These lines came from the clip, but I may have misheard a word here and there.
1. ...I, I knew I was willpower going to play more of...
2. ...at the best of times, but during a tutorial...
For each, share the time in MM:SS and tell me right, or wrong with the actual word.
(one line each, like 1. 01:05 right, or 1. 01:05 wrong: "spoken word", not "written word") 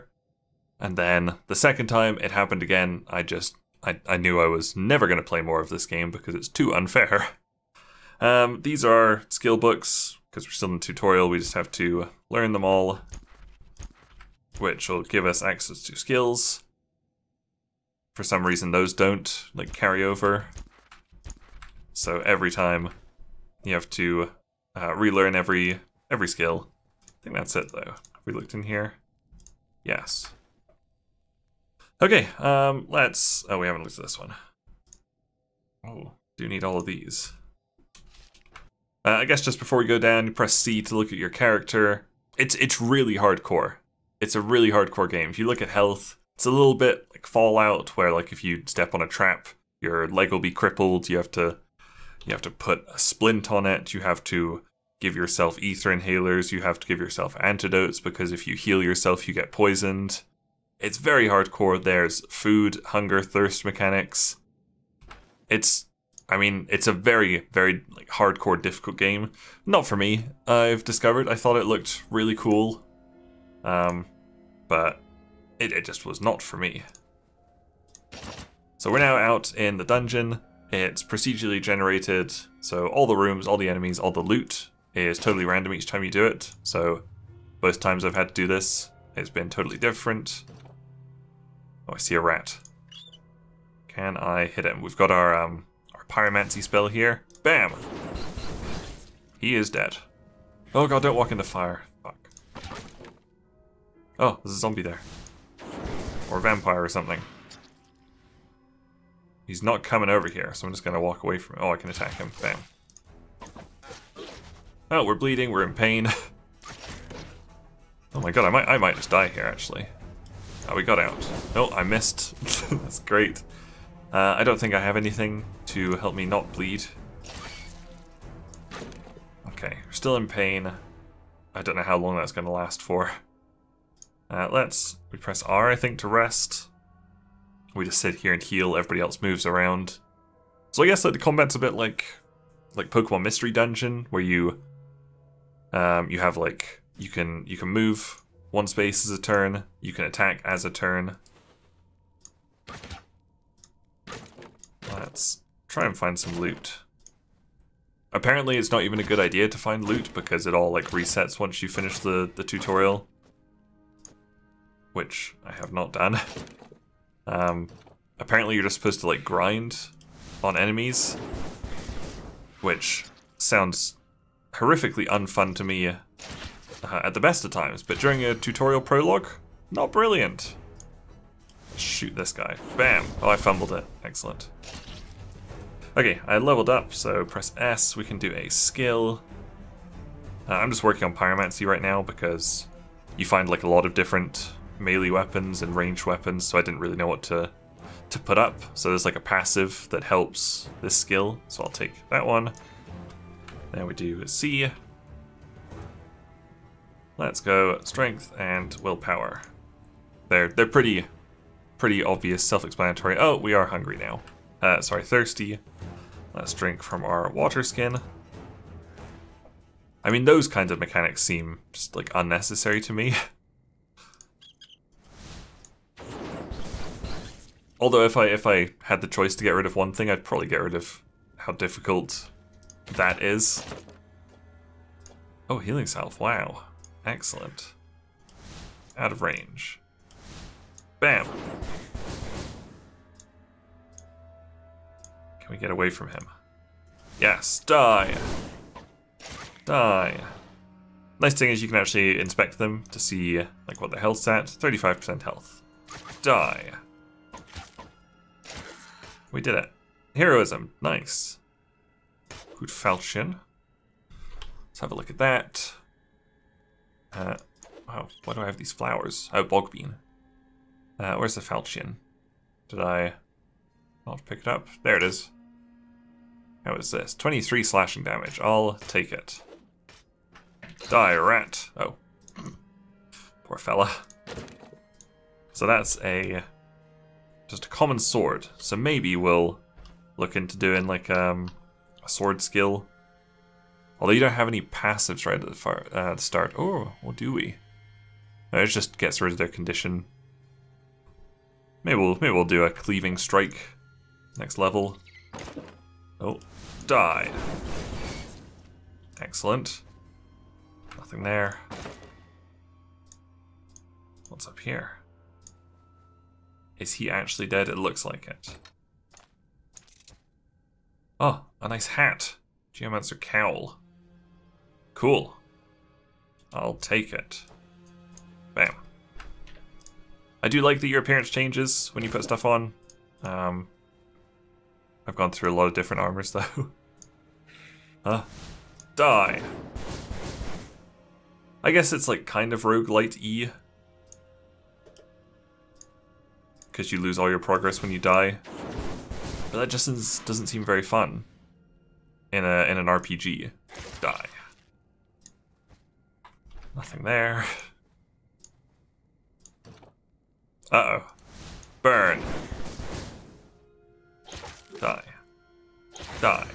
1. 00:03 wrong: "never", not "willpower"
2. 02:57 right.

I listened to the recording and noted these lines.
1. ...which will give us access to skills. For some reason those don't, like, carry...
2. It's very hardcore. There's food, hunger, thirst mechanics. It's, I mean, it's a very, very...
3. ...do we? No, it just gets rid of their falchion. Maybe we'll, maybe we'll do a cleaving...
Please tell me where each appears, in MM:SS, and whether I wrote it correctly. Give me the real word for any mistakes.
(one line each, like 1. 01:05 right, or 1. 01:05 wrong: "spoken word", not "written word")
1. 00:14 right
2. 01:00 right
3. 04:57 wrong: "condition", not "falchion".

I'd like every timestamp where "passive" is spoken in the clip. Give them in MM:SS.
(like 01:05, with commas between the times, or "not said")
03:19, 04:54.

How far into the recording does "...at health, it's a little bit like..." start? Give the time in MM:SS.
00:45.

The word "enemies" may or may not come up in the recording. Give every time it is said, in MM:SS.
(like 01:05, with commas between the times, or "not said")
01:23, 02:50.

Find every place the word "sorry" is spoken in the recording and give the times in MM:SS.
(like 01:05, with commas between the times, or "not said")
03:34.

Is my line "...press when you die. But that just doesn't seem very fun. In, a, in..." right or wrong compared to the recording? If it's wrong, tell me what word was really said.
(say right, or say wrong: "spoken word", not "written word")
wrong: "progress", not "press".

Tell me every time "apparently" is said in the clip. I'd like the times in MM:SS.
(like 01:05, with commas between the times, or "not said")
02:38, 02:48.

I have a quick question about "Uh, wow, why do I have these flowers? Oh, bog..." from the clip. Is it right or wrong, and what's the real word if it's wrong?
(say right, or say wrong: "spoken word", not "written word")
right.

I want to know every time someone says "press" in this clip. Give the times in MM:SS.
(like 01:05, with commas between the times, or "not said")
00:40, 02:15, 03:07.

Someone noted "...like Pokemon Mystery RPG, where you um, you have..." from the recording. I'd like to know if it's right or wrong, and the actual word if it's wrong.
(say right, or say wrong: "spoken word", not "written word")
wrong: "Dungeon", not "RPG".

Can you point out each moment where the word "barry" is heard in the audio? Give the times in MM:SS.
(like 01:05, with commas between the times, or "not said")
not said.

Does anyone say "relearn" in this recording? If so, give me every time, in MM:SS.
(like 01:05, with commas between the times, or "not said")
00:24.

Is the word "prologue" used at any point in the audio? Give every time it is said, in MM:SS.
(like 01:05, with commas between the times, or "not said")
02:58.